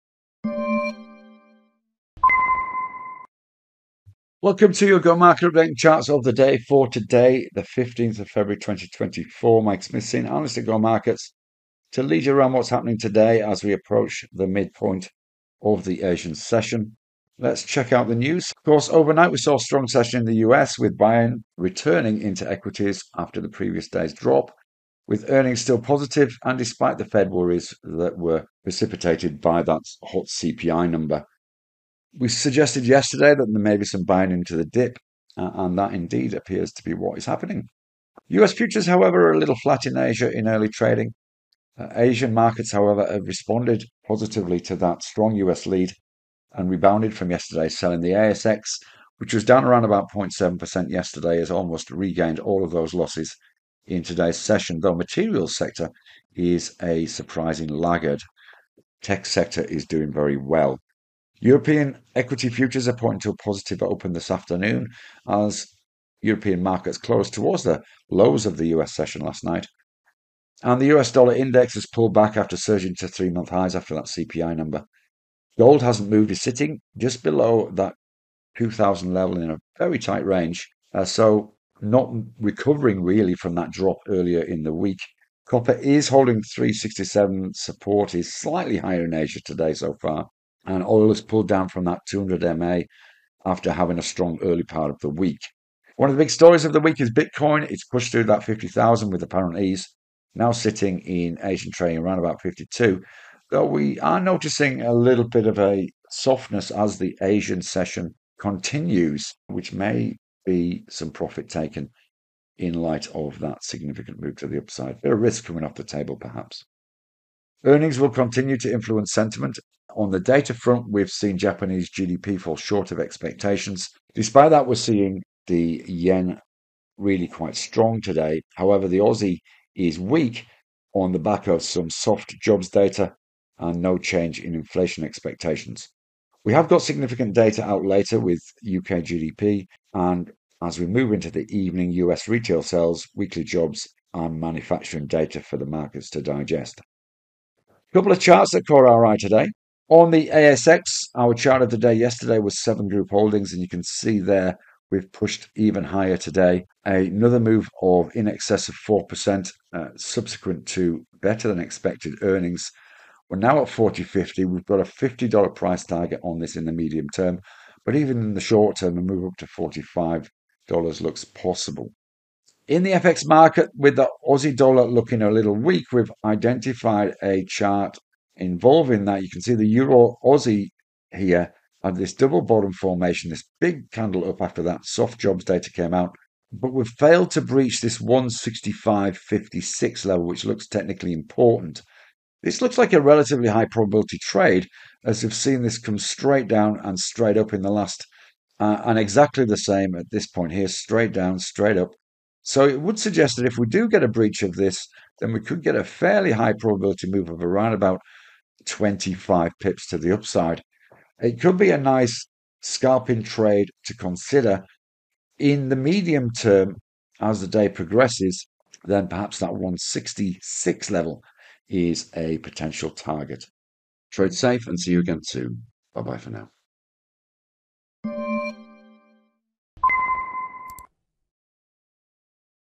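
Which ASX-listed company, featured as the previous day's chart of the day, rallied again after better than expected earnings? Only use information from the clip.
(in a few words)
Seven Group Holdings.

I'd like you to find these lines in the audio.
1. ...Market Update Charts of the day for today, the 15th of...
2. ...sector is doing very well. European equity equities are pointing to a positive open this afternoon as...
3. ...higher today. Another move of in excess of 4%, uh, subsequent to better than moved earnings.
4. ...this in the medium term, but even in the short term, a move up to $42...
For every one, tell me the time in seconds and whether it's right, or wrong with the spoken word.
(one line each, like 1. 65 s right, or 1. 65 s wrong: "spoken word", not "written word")
1. 5 s right
2. 59 s wrong: "futures", not "equities"
3. 155 s wrong: "expected", not "moved"
4. 166 s wrong: "45", not "42".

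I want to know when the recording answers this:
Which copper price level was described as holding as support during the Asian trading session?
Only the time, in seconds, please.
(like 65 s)
86 s.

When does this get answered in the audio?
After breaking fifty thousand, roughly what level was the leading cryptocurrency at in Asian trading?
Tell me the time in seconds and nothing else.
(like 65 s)
102 s.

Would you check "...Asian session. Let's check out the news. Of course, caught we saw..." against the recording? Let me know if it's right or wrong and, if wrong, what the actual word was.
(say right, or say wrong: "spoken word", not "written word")
wrong: "overnight", not "caught".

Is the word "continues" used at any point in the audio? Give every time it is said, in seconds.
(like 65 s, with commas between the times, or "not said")
108 s, 118 s.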